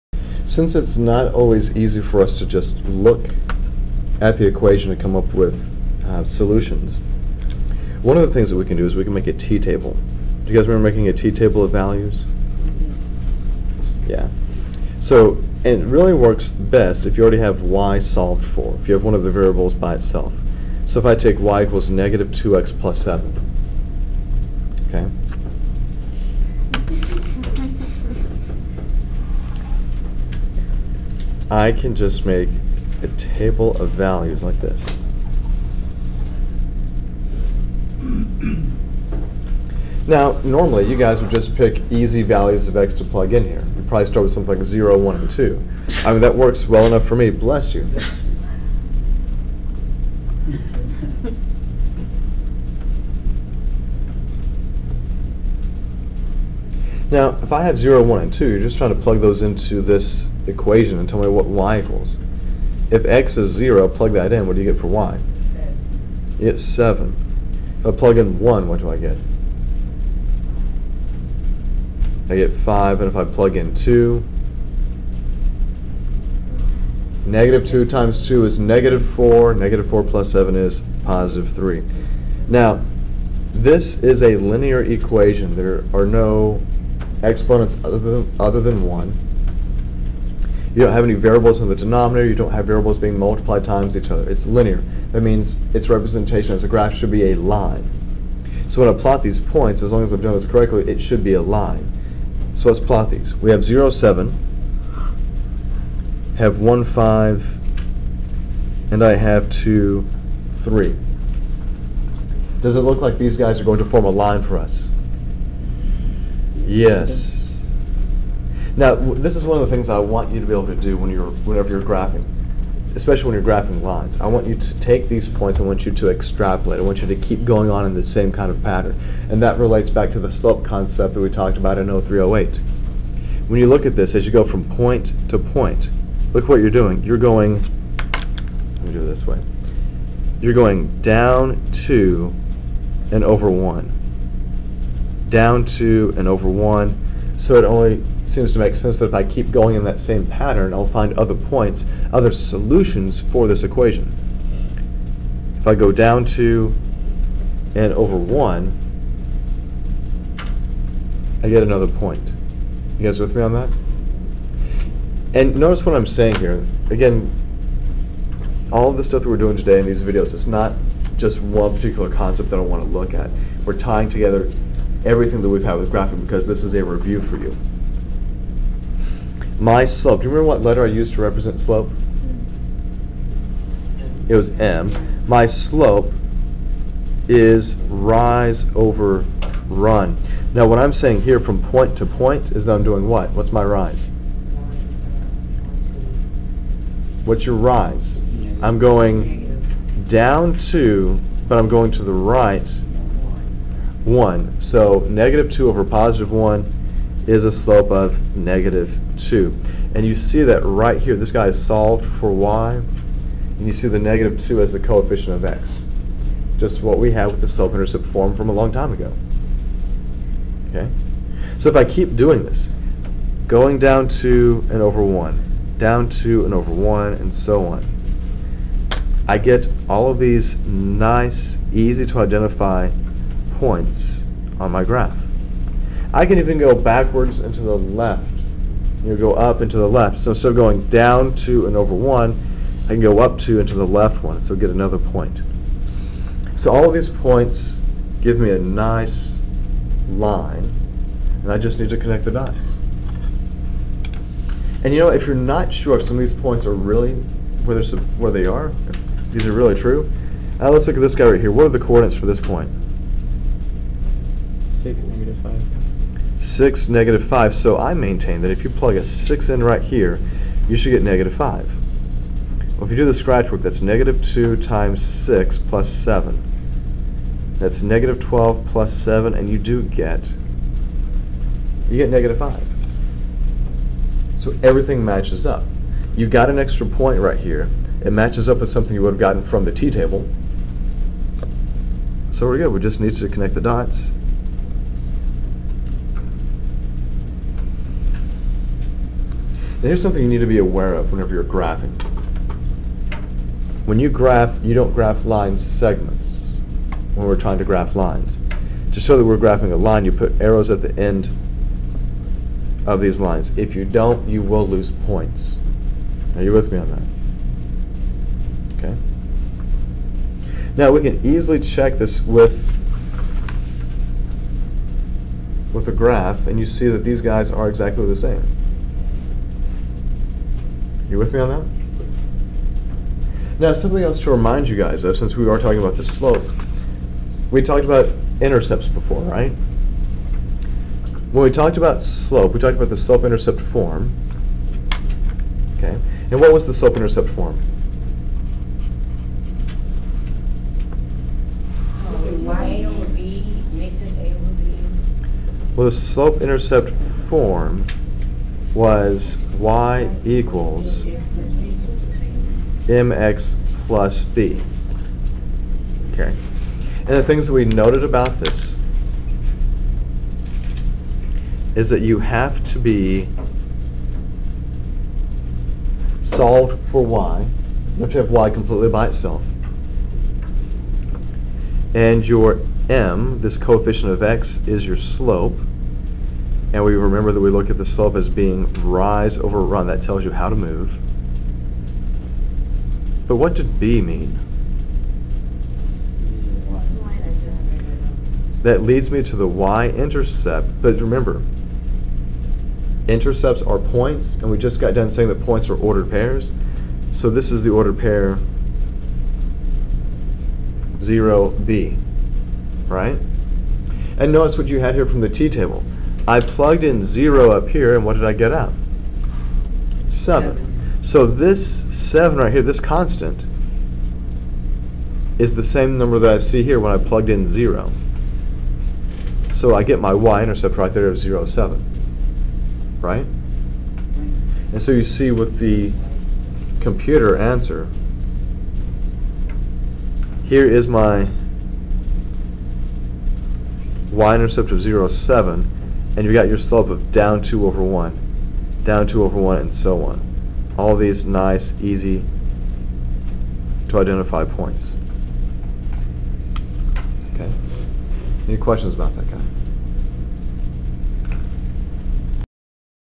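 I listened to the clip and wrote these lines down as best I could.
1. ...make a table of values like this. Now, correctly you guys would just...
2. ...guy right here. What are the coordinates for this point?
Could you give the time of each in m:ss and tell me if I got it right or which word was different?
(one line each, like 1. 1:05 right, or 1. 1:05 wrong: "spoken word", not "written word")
1. 0:32 wrong: "normally", not "correctly"
2. 4:21 right.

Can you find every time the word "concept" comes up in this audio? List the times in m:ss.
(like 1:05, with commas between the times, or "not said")
2:10, 2:52.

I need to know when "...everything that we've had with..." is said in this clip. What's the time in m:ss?
2:55.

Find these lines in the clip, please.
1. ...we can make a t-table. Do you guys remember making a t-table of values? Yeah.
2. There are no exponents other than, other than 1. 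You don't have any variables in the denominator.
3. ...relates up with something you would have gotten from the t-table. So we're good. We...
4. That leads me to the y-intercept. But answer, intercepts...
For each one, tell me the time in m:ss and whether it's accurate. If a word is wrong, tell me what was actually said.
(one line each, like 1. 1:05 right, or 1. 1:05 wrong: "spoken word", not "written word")
1. 0:08 right
2. 1:25 right
3. 4:48 wrong: "matches", not "relates"
4. 6:38 wrong: "remember", not "answer".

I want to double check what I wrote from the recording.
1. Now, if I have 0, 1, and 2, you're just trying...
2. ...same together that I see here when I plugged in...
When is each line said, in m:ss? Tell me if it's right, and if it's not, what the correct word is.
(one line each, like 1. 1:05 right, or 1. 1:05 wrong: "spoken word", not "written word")
1. 0:57 right
2. 7:05 wrong: "number", not "together".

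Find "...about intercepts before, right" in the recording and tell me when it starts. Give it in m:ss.
5:37.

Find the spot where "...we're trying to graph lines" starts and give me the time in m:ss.
5:07.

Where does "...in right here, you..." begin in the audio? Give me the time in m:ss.
4:29.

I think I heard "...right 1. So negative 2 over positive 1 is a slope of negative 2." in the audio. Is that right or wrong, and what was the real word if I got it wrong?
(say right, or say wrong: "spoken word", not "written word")
right.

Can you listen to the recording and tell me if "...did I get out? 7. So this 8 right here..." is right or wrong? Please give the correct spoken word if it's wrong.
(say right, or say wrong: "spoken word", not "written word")
wrong: "7", not "8".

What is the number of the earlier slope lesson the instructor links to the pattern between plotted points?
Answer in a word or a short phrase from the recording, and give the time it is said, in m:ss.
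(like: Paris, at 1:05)
0308, at 2:11.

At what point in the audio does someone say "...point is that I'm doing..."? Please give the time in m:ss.
3:12.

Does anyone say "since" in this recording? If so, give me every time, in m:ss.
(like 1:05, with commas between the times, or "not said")
0:00, 5:35.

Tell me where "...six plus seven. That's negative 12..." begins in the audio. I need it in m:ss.
4:35.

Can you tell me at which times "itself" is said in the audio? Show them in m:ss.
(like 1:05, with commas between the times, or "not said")
0:19, 6:19.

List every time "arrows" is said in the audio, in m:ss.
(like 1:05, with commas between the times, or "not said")
5:10.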